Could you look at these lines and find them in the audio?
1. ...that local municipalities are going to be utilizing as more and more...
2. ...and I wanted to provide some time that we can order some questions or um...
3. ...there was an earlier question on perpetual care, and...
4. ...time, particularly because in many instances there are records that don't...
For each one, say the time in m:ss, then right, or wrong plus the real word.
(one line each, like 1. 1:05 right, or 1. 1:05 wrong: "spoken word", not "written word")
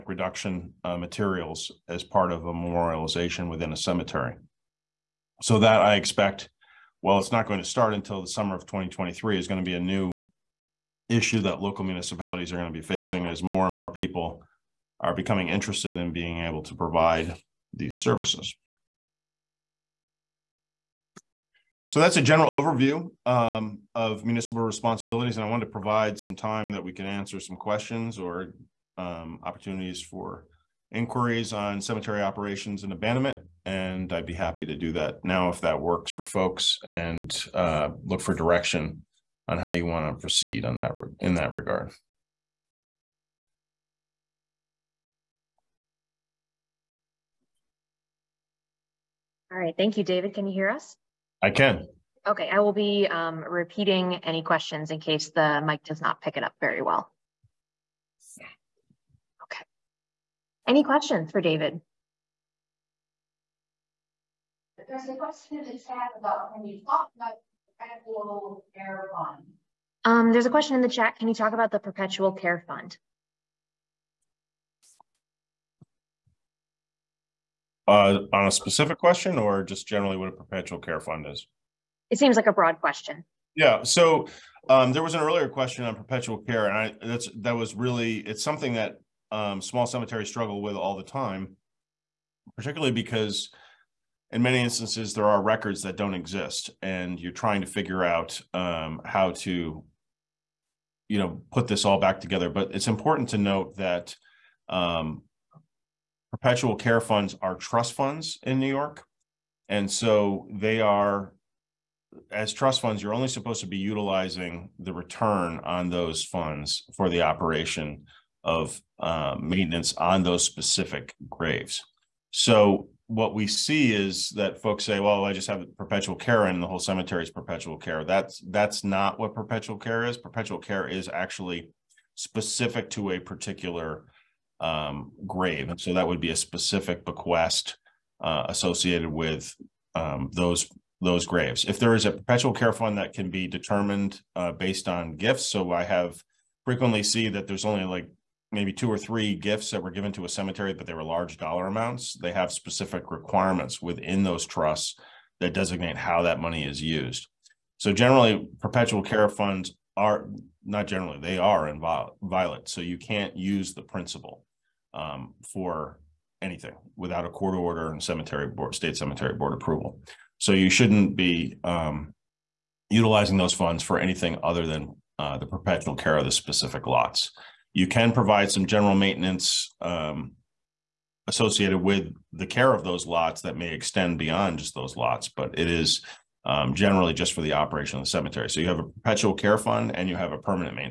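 1. 0:11 wrong: "facing", not "utilizing"
2. 0:25 wrong: "answer", not "order"
3. 1:24 right
4. 1:31 right.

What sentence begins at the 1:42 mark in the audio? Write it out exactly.
But it's important to note that um, perpetual care funds are trust funds in New York.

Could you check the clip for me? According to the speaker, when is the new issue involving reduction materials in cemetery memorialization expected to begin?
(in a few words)
summer of 2023.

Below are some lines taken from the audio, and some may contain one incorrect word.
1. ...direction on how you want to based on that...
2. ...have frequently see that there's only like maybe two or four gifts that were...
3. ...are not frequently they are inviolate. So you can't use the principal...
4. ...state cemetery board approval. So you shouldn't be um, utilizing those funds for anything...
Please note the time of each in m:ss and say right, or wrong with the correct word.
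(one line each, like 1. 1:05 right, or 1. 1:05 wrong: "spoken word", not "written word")
1. 0:38 wrong: "proceed", not "based"
2. 2:25 wrong: "three", not "four"
3. 2:39 wrong: "generally", not "frequently"
4. 2:48 right.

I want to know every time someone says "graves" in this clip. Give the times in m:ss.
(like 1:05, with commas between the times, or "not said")
2:01, 2:15, 2:21.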